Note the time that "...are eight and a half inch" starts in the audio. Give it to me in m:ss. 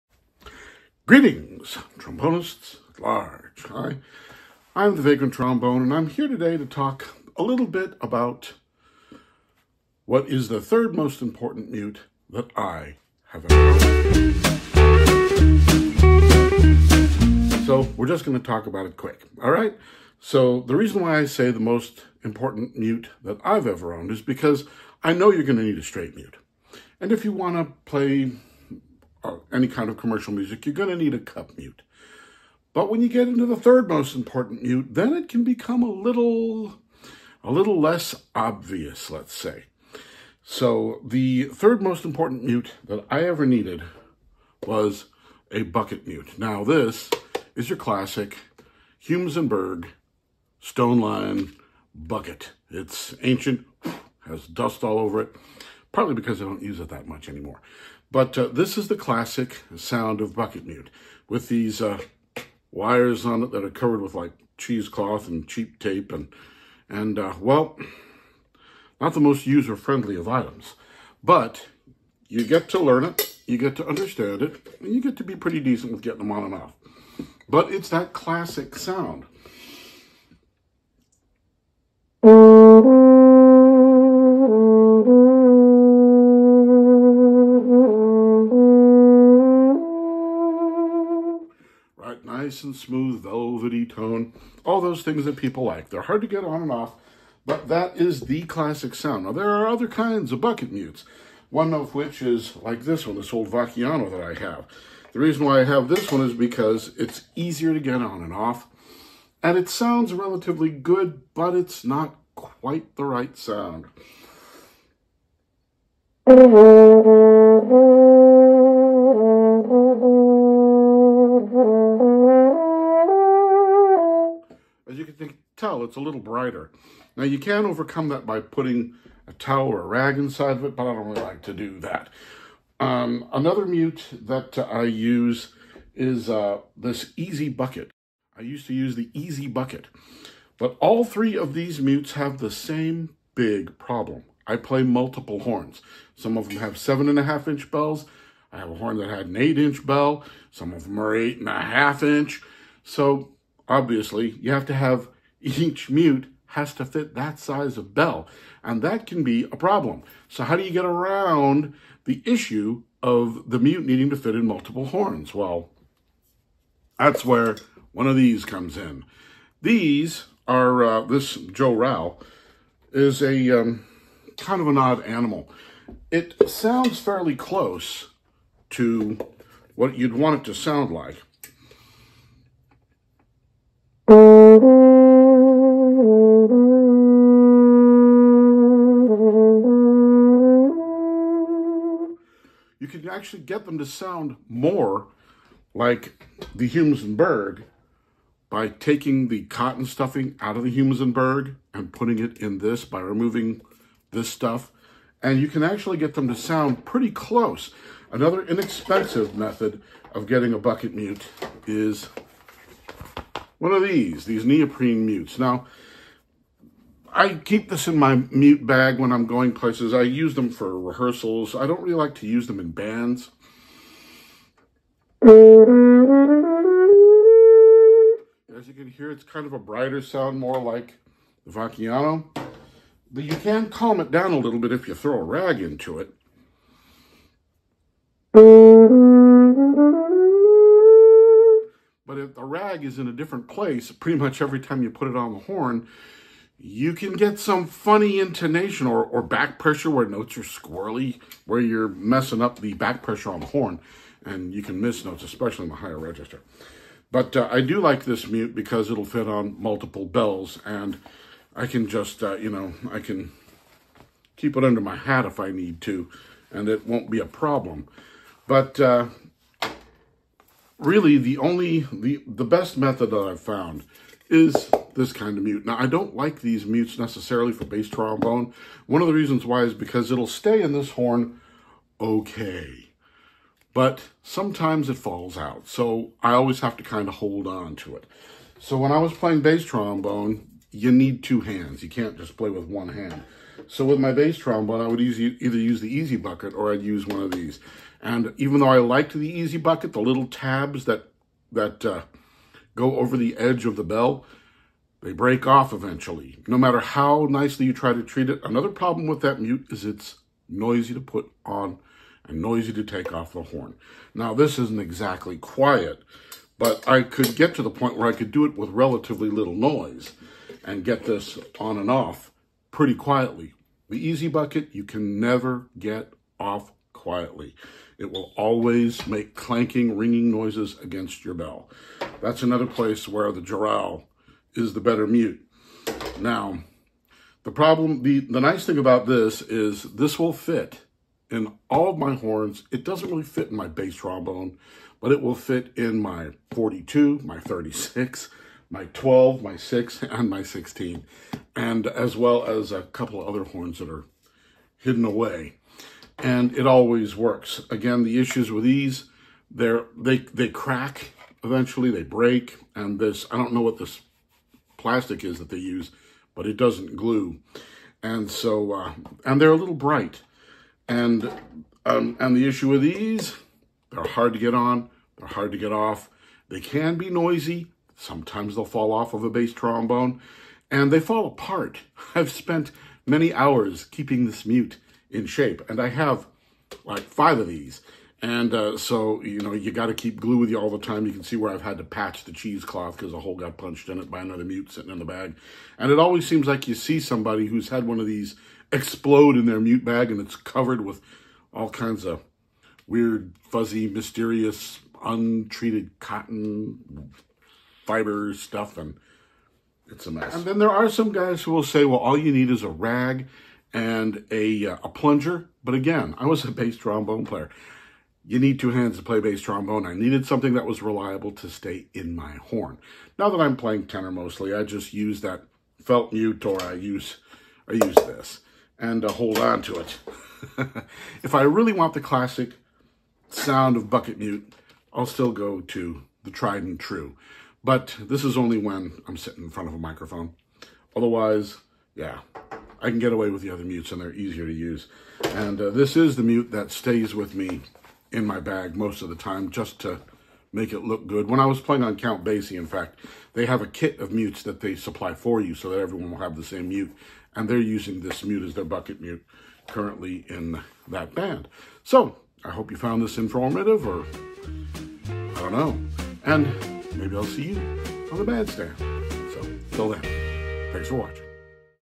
2:30.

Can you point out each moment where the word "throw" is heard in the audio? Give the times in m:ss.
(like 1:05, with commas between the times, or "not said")
3:54.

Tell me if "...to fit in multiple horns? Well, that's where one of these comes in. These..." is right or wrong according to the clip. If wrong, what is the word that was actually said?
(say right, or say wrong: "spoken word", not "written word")
right.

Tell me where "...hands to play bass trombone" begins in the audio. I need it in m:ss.
6:58.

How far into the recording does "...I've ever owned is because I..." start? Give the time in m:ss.
0:23.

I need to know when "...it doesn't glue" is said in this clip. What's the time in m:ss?
6:06.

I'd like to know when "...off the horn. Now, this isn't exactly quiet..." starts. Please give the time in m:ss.
5:13.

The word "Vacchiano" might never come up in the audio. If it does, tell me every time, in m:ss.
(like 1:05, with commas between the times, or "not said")
1:43, 3:51.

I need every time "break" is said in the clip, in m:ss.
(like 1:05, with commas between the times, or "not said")
5:05, 6:02.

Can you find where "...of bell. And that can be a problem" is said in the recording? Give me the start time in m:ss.
2:37.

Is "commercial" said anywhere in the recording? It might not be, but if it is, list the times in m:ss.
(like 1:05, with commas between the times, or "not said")
0:29.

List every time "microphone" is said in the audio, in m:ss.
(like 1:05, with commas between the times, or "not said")
7:19.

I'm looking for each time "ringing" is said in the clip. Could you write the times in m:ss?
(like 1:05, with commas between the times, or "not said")
5:29.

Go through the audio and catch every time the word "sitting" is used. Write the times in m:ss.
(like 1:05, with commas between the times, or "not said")
6:34, 7:19.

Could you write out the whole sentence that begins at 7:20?
Otherwise, yeah, I can get away with the other mutes and they're easier to use.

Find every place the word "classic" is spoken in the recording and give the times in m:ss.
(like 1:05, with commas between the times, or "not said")
0:47, 0:58, 1:18, 1:38, 7:12.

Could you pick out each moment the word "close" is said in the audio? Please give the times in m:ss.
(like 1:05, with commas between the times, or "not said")
2:57, 3:27.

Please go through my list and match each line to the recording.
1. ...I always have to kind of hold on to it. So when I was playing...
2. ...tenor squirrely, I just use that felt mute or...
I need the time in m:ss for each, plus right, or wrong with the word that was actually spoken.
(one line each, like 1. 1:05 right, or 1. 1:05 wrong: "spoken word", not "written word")
1. 4:46 right
2. 7:03 wrong: "mostly", not "squirrely".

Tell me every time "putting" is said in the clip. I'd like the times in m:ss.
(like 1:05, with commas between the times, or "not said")
2:08, 3:21.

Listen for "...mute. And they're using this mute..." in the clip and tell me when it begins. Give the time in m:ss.
7:36.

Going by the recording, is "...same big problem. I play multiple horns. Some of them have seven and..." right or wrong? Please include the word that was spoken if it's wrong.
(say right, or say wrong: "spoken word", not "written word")
right.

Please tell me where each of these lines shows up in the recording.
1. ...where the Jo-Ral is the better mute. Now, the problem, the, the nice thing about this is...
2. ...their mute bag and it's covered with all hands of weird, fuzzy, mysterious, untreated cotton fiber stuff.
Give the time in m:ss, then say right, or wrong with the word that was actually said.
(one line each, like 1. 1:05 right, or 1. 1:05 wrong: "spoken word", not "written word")
1. 5:33 right
2. 6:39 wrong: "kinds", not "hands".